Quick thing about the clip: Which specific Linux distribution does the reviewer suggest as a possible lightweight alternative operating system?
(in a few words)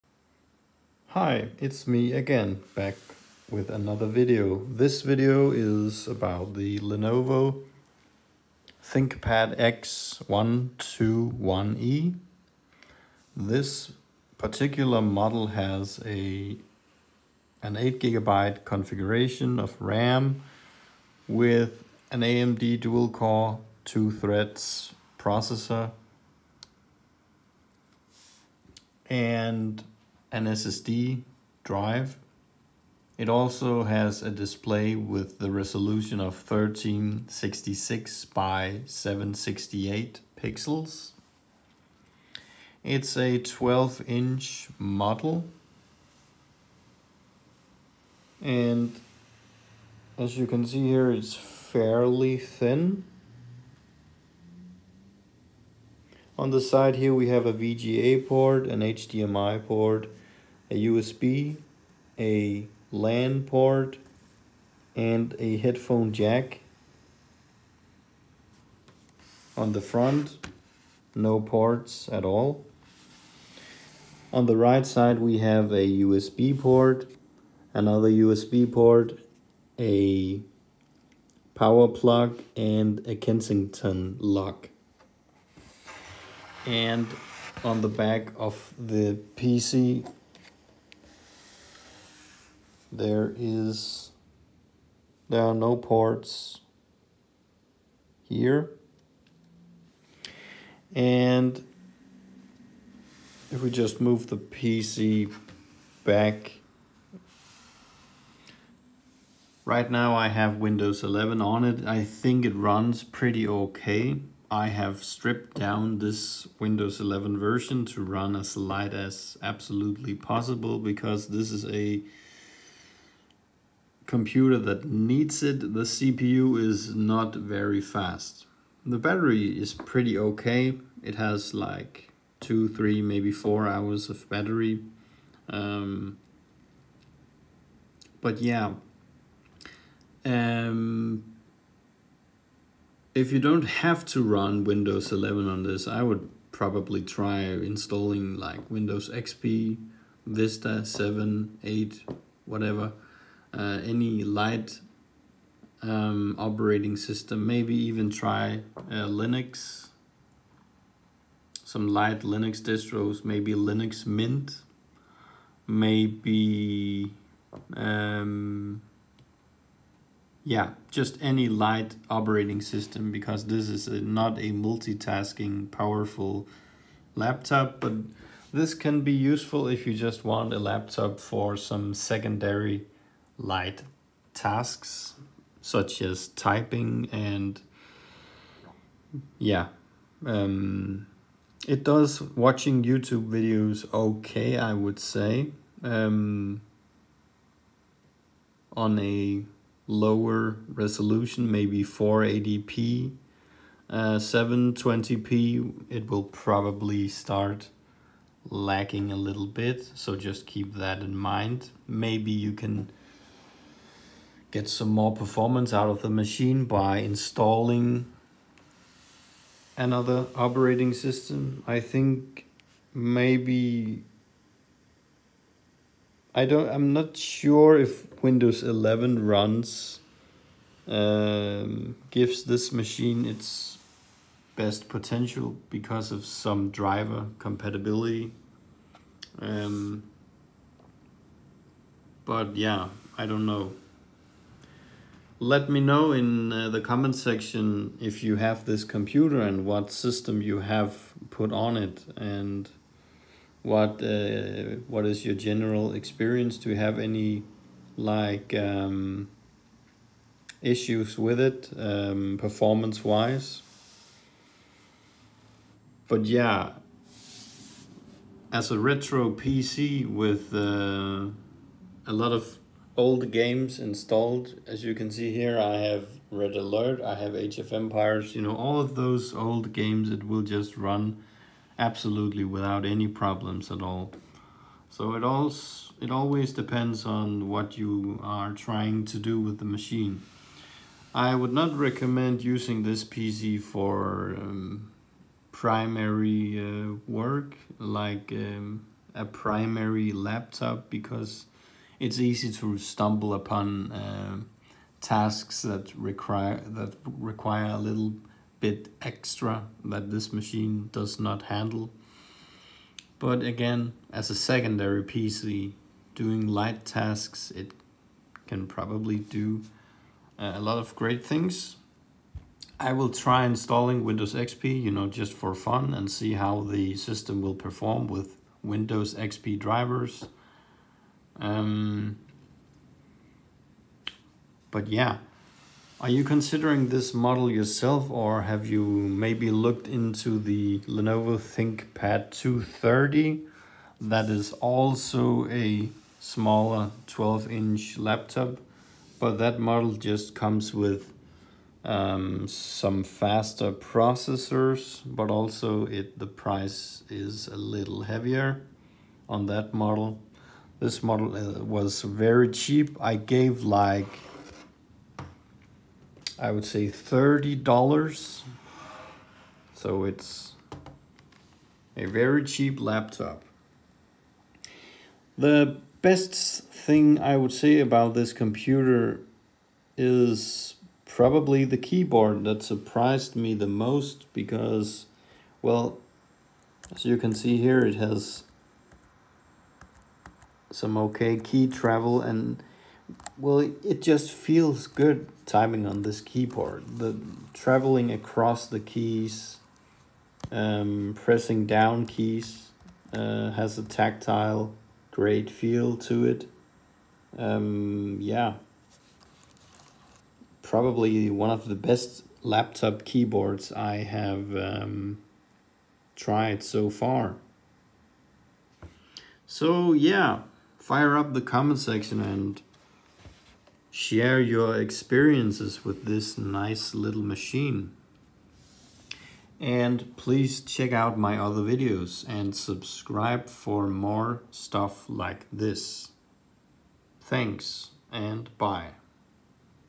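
Linux Mint.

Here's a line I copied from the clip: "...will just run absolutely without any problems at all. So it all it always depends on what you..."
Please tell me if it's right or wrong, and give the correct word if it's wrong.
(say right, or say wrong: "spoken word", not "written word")
right.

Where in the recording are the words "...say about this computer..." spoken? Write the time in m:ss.
6:17.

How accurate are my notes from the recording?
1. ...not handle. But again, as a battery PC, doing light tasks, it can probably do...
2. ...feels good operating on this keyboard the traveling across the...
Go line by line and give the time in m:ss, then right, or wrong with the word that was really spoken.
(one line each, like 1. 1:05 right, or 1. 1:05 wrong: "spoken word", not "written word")
1. 5:11 wrong: "secondary", not "battery"
2. 6:34 wrong: "timing", not "operating".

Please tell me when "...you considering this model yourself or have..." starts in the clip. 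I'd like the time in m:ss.
5:36.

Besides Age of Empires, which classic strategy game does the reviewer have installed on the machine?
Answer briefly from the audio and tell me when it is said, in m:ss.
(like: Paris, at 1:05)
Red Alert, at 4:36.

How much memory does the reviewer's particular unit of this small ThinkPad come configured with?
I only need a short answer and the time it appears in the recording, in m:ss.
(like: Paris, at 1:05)
8 gigabytes, at 0:17.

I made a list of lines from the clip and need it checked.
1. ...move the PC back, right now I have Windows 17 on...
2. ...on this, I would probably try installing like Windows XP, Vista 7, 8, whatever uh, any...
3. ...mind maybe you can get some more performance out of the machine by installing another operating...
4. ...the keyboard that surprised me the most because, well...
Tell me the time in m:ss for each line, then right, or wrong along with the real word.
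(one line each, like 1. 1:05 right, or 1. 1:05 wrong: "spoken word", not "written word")
1. 1:44 wrong: "11", not "17"
2. 2:25 right
3. 3:31 right
4. 6:21 right.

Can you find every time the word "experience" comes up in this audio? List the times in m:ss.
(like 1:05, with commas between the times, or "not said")
4:15, 7:04.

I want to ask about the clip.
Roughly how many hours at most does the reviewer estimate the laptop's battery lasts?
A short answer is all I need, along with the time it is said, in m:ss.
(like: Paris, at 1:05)
4 hours, at 2:13.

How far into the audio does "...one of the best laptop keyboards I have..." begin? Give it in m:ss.
6:51.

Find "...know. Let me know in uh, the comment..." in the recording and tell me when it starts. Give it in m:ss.
4:03.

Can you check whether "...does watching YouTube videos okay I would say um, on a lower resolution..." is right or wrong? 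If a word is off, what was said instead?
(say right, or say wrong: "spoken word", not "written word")
right.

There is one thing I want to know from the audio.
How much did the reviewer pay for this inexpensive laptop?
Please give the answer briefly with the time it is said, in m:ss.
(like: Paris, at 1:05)
$30, at 6:06.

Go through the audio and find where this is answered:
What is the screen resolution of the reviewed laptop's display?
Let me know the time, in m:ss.
0:36.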